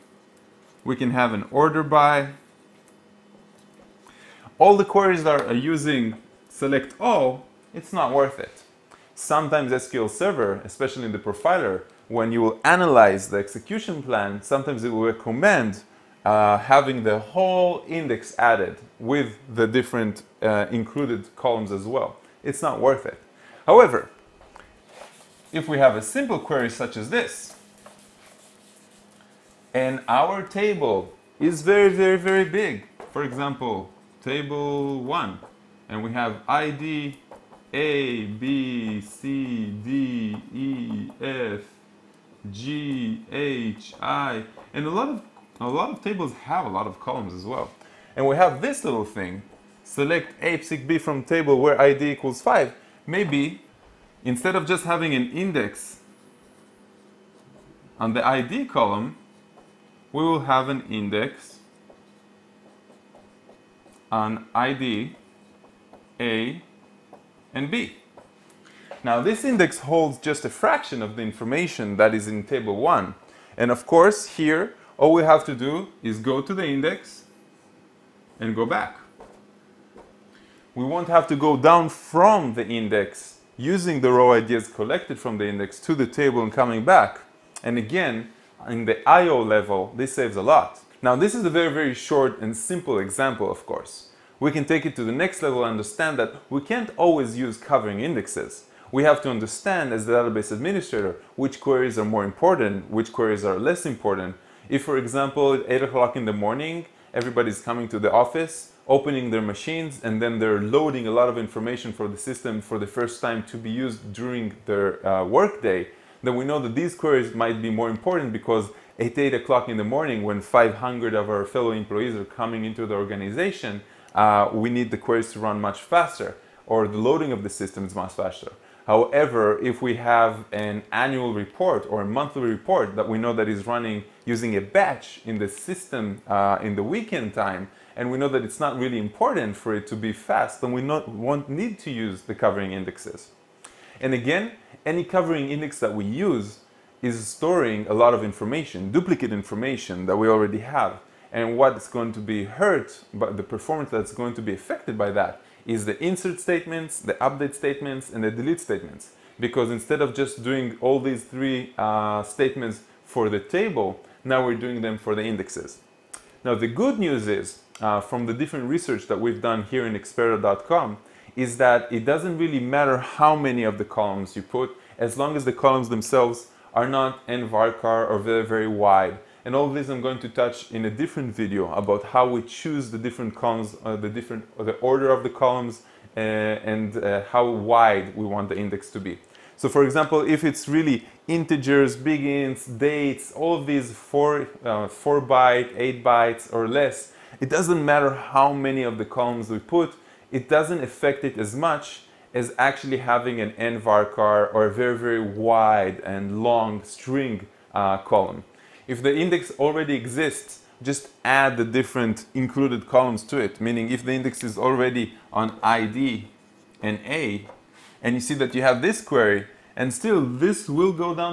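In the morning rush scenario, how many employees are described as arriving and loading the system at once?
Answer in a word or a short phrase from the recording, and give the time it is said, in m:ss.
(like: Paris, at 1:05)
500, at 2:00.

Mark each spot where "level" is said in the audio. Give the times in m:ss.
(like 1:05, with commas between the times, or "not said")
1:29, 1:35.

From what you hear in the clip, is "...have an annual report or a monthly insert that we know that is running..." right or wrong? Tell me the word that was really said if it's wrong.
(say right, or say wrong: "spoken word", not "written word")
wrong: "report", not "insert".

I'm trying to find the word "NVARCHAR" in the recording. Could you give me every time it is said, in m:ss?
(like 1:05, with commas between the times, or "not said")
2:57, 3:23.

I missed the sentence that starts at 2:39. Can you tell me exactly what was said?
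Because instead of just doing all these three uh, statements for the table, now we're doing them for the indexes.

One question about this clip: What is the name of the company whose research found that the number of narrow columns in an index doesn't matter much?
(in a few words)
Experda.com.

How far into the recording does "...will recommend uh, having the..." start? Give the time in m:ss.
0:14.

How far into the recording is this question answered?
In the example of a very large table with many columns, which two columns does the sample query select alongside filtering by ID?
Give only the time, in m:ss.
0:49.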